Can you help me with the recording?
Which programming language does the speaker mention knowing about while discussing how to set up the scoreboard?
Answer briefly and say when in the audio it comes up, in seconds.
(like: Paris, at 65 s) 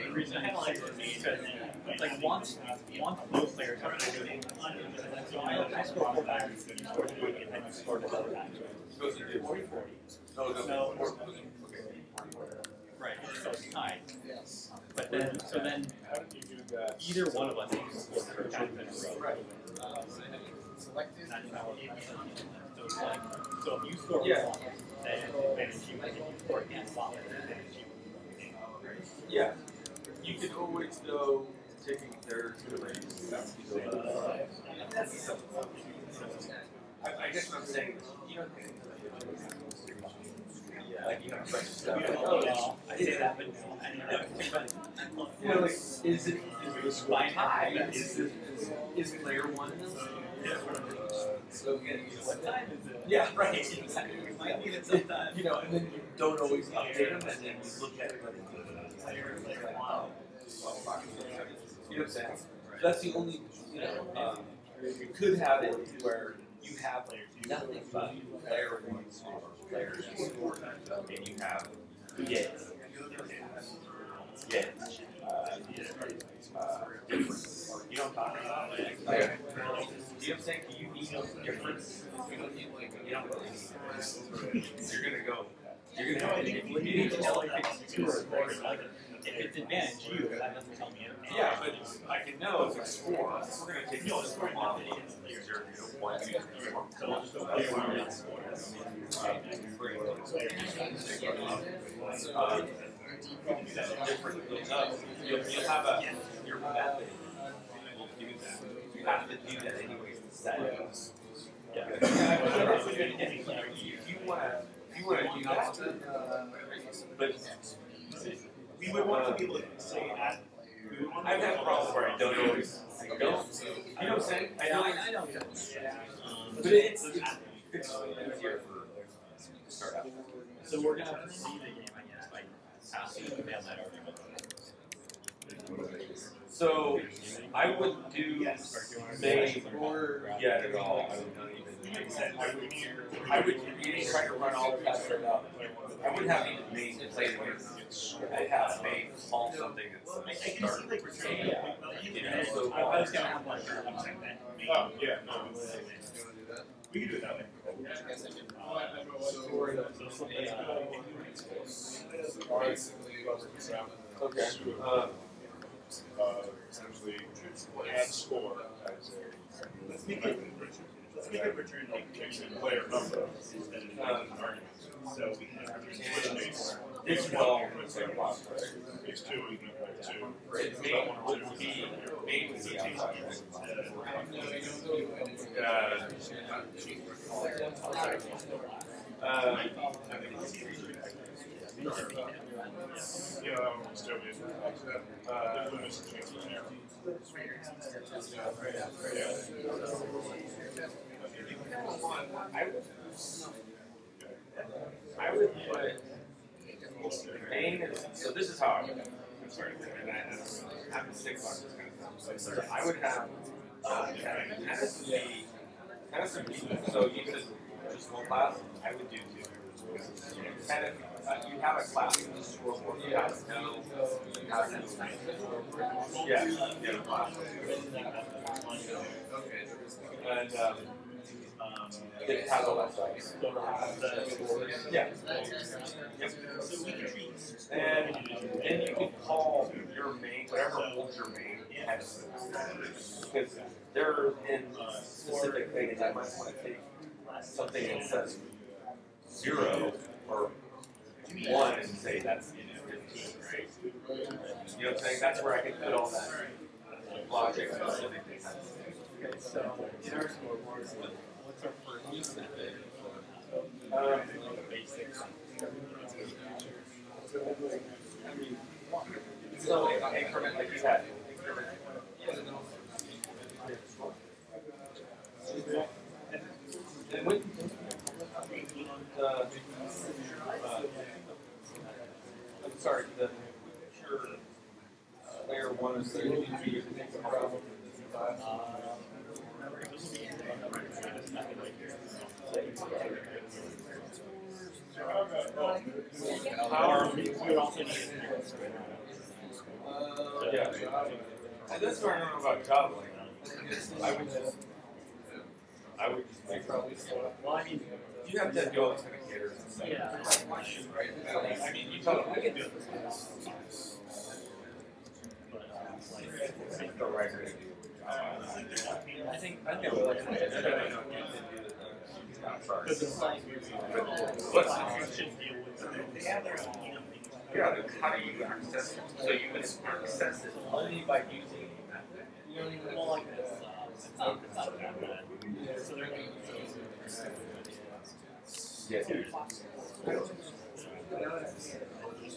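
Java, at 302 s.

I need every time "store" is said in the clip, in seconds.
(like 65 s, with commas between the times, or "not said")
69 s.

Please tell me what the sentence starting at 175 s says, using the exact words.
So we can return which it's two two.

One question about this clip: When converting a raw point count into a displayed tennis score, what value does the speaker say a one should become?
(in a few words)
15.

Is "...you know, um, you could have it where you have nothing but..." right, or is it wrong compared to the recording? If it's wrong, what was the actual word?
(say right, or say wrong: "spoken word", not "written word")
right.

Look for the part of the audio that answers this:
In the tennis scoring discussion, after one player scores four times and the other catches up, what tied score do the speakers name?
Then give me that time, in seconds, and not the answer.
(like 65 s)
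9 s.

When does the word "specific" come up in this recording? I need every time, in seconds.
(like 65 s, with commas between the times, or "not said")
245 s, 257 s.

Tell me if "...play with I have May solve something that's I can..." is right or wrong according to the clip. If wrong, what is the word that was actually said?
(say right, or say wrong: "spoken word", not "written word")
right.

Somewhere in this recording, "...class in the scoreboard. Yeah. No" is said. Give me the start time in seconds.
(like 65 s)
221 s.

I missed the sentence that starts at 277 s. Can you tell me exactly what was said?
And when, uh, sorry, the sure uh, layer one is the to be a problem.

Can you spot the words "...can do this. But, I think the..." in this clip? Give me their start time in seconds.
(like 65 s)
312 s.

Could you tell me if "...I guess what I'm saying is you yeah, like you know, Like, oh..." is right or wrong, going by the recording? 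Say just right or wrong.
right.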